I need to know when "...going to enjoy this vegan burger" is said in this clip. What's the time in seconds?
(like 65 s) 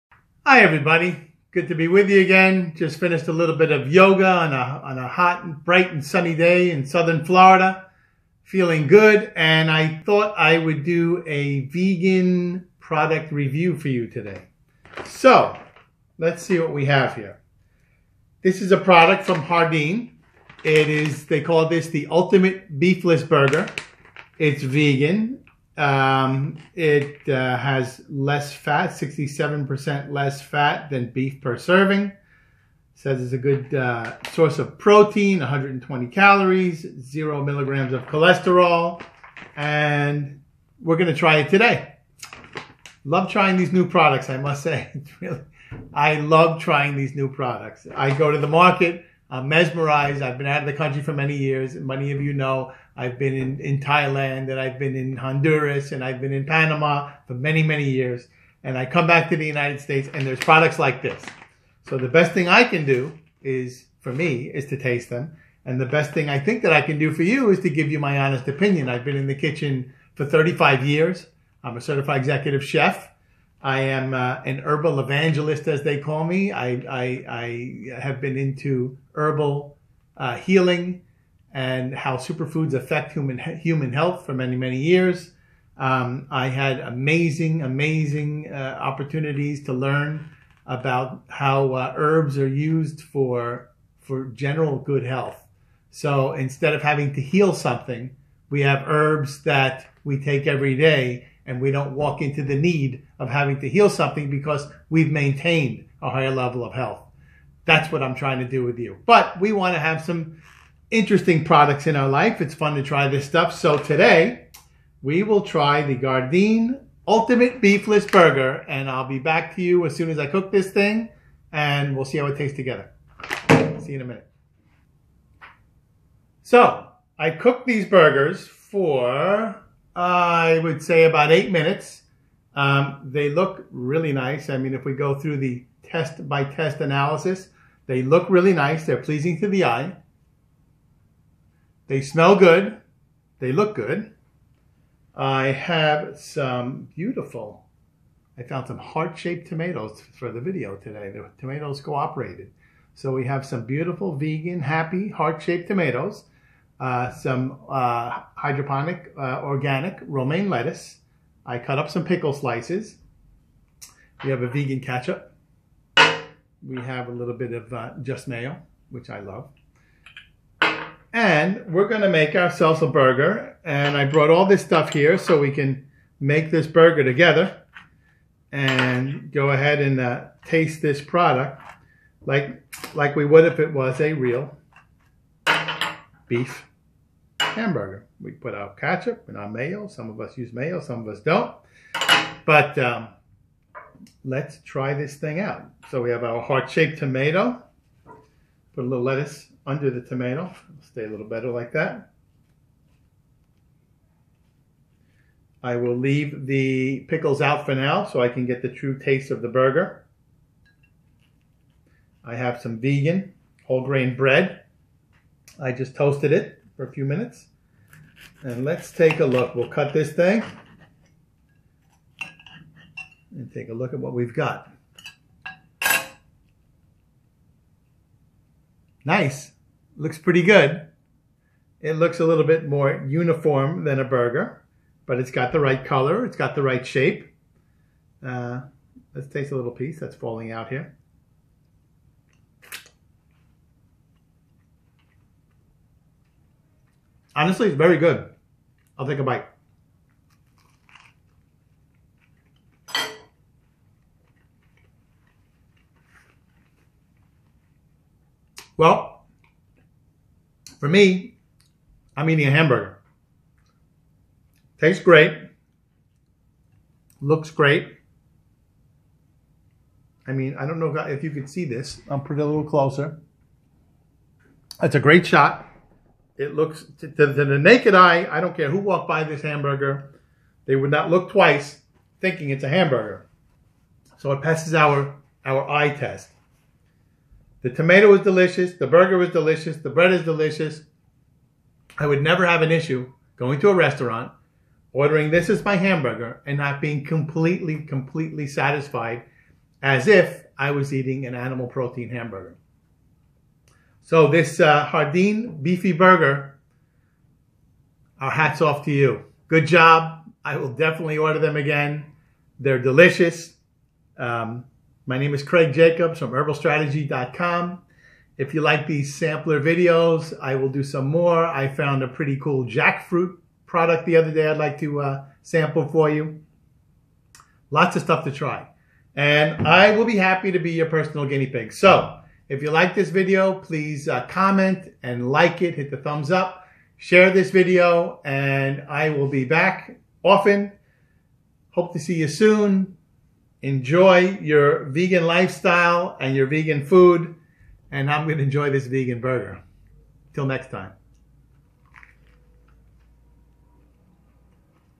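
348 s.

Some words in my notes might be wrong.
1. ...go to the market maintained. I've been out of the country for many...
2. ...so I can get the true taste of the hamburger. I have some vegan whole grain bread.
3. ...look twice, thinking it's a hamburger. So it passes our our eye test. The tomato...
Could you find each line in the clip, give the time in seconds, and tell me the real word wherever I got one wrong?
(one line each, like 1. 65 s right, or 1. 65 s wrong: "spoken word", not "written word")
1. 48 s wrong: "mesmerized", not "maintained"
2. 208 s wrong: "burger", not "hamburger"
3. 281 s right.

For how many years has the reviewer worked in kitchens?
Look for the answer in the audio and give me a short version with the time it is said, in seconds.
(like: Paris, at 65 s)
35 years, at 70 s.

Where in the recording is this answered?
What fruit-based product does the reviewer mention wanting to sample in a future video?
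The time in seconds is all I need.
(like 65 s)
322 s.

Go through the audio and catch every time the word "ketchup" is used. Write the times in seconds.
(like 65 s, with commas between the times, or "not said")
164 s, 188 s.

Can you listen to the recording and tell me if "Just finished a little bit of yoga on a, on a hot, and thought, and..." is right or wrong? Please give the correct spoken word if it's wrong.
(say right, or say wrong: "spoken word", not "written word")
wrong: "bright", not "thought".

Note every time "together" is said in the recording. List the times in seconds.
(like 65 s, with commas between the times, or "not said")
122 s, 177 s.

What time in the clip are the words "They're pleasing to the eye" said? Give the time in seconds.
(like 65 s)
138 s.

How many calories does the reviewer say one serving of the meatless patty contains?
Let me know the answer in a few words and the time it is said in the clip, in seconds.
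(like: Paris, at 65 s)
120, at 35 s.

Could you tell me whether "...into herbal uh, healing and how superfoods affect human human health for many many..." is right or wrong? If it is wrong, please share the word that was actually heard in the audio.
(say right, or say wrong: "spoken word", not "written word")
right.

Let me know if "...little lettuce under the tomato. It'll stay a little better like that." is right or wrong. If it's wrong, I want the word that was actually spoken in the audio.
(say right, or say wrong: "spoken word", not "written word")
right.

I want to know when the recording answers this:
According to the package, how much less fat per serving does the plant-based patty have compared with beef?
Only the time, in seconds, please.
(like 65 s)
28 s.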